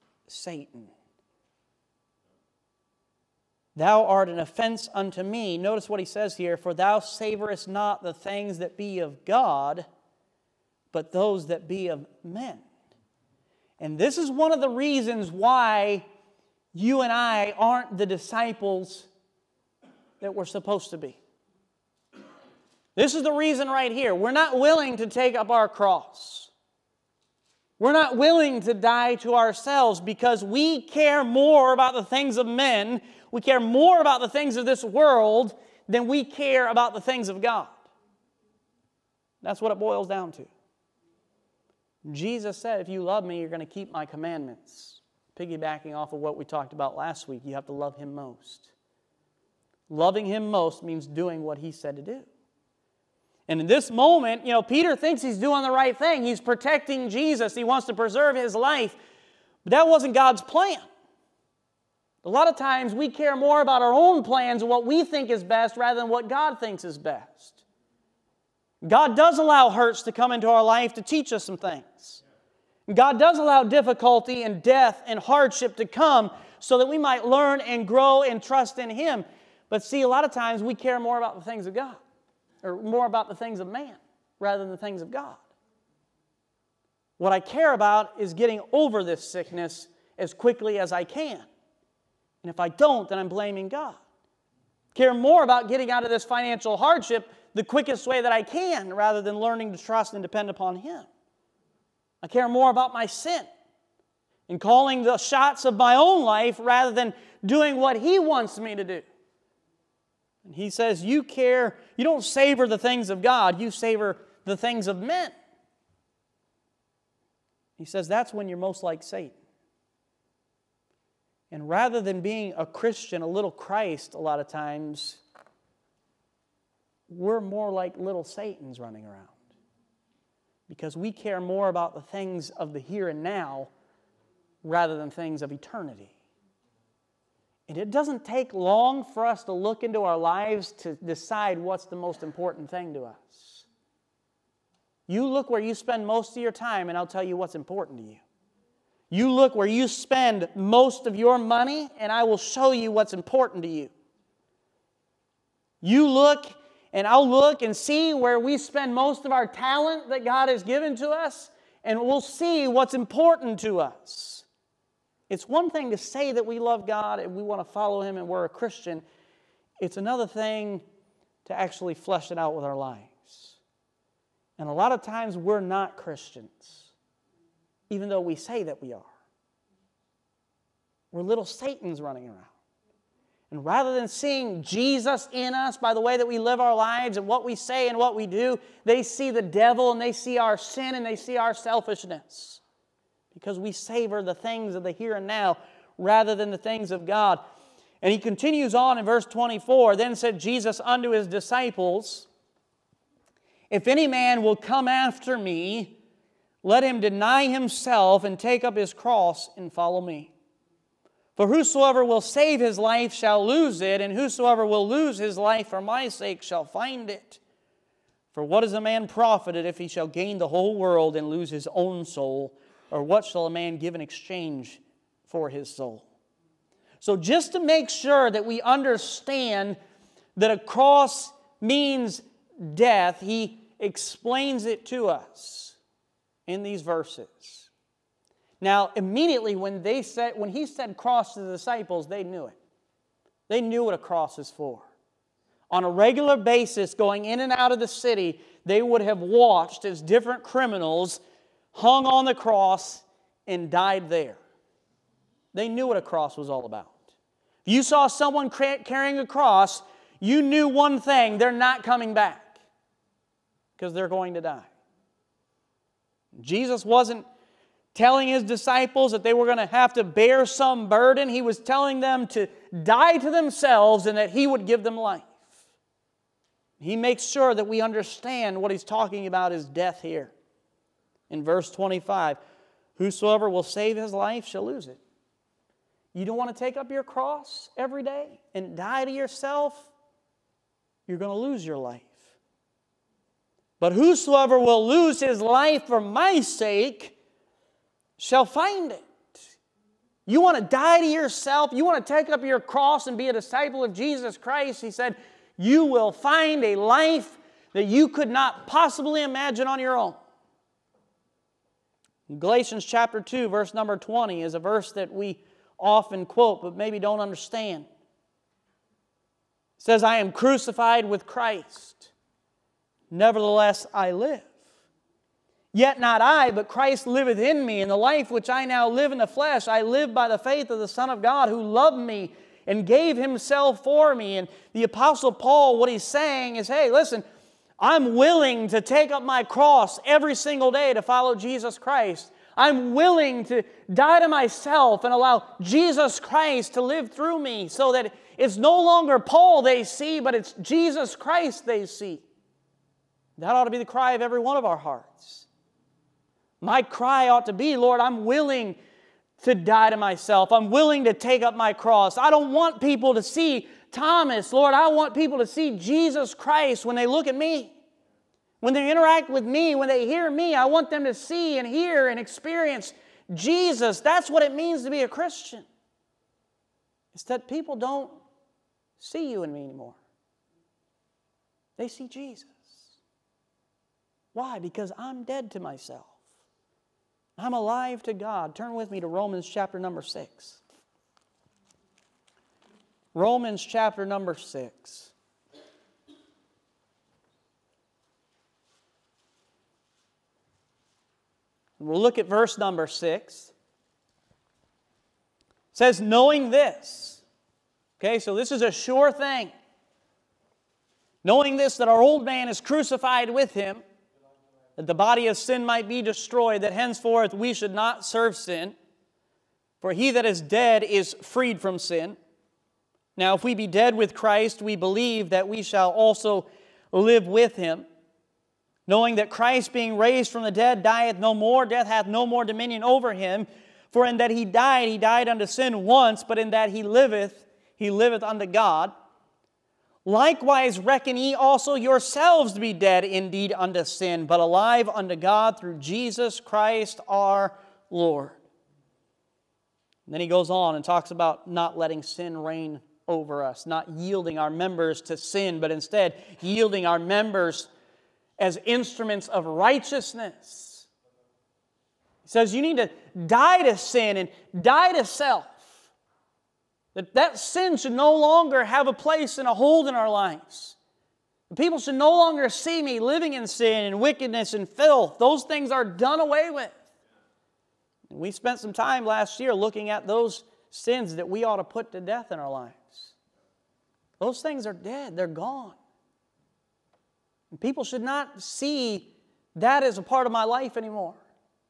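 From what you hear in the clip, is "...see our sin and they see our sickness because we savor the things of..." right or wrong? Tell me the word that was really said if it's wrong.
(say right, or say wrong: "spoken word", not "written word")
wrong: "selfishness", not "sickness".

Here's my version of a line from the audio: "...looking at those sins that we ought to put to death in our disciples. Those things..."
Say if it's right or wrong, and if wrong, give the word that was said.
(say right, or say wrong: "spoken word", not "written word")
wrong: "lives", not "disciples".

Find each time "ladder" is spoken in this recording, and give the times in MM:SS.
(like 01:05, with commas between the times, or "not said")
not said.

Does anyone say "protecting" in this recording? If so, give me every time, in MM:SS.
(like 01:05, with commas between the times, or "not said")
00:56.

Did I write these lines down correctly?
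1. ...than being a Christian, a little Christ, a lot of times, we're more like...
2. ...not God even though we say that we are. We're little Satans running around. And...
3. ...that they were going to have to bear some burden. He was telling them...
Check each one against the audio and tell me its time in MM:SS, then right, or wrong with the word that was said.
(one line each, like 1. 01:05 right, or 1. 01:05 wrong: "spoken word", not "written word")
1. 02:02 right
2. 02:55 wrong: "Christians", not "God"
3. 04:29 right.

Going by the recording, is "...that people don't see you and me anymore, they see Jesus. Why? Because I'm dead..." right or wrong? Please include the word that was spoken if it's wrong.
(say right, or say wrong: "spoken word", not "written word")
right.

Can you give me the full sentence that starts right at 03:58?
Now, immediately when, they said, when he said cross to the disciples, they knew it.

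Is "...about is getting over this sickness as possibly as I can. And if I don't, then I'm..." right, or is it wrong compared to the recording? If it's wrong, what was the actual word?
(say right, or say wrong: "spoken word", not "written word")
wrong: "quickly", not "possibly".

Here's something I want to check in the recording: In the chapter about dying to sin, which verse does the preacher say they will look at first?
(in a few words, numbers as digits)
6.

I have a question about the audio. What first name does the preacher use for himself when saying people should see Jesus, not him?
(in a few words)
Thomas.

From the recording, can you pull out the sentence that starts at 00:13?
And this is one of the reasons why you and I aren't the disciples that we're supposed to be.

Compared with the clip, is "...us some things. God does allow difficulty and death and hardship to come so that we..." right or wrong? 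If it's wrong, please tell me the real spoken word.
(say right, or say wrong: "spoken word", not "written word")
right.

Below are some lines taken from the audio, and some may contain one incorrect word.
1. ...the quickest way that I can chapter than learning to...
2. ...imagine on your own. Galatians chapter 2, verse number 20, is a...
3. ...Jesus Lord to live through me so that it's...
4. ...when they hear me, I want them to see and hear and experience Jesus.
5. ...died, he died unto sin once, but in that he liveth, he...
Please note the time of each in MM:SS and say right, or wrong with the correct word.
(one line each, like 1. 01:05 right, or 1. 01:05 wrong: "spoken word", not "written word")
1. 01:37 wrong: "rather", not "chapter"
2. 05:09 right
3. 05:45 wrong: "Christ", not "Lord"
4. 06:09 right
5. 07:14 right.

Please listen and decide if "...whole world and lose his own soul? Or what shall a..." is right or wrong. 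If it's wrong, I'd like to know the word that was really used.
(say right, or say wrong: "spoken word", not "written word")
right.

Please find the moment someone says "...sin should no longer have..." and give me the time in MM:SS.
07:47.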